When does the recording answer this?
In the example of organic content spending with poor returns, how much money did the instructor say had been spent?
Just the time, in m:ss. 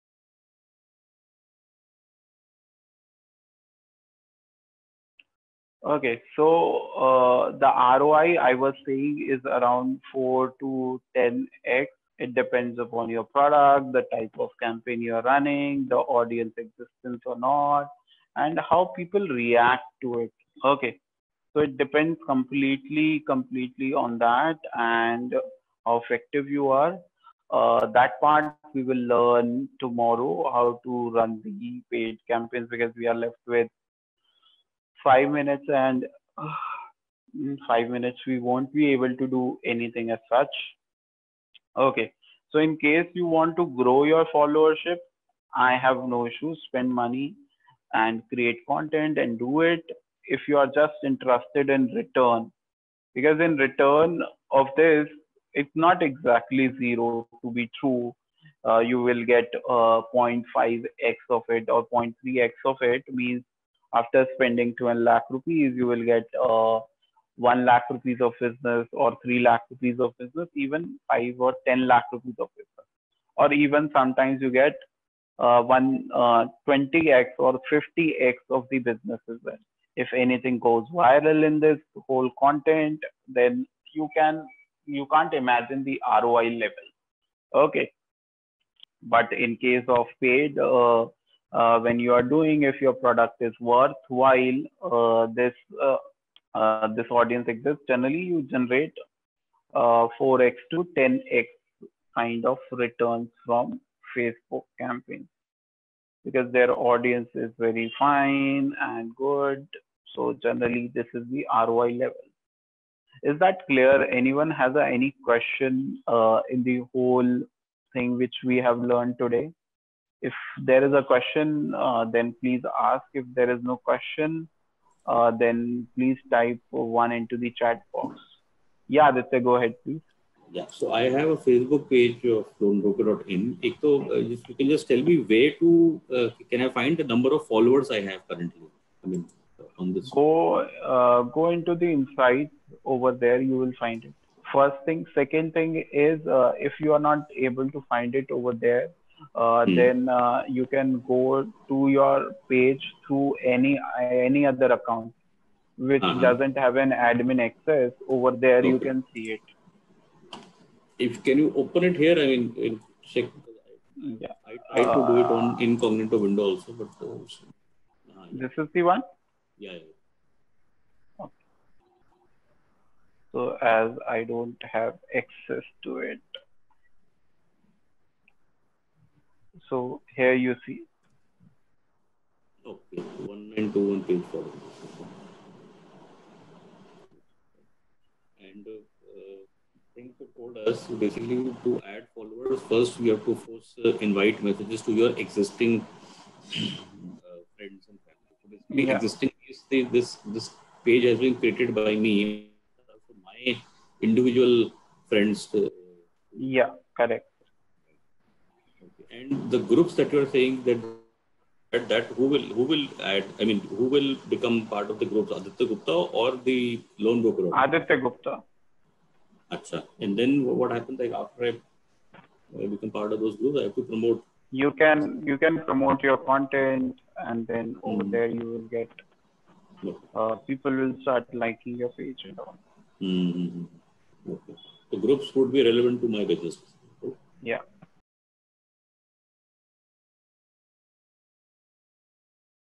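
1:04.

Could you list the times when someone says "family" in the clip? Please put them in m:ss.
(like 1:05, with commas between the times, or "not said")
3:18.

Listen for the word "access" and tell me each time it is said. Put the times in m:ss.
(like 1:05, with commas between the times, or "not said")
2:37, 2:55.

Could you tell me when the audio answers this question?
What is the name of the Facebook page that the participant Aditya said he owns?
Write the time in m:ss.
2:12.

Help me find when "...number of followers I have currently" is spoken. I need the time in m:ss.
2:17.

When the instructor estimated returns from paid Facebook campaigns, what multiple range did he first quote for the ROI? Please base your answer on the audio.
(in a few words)
4 to 10x.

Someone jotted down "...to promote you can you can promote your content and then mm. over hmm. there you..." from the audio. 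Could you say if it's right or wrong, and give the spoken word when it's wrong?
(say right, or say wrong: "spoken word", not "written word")
right.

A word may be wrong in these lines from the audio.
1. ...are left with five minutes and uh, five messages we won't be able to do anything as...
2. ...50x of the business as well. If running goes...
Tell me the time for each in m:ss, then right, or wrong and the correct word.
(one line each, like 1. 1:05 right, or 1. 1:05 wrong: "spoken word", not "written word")
1. 0:33 wrong: "minutes", not "messages"
2. 1:17 wrong: "anything", not "running".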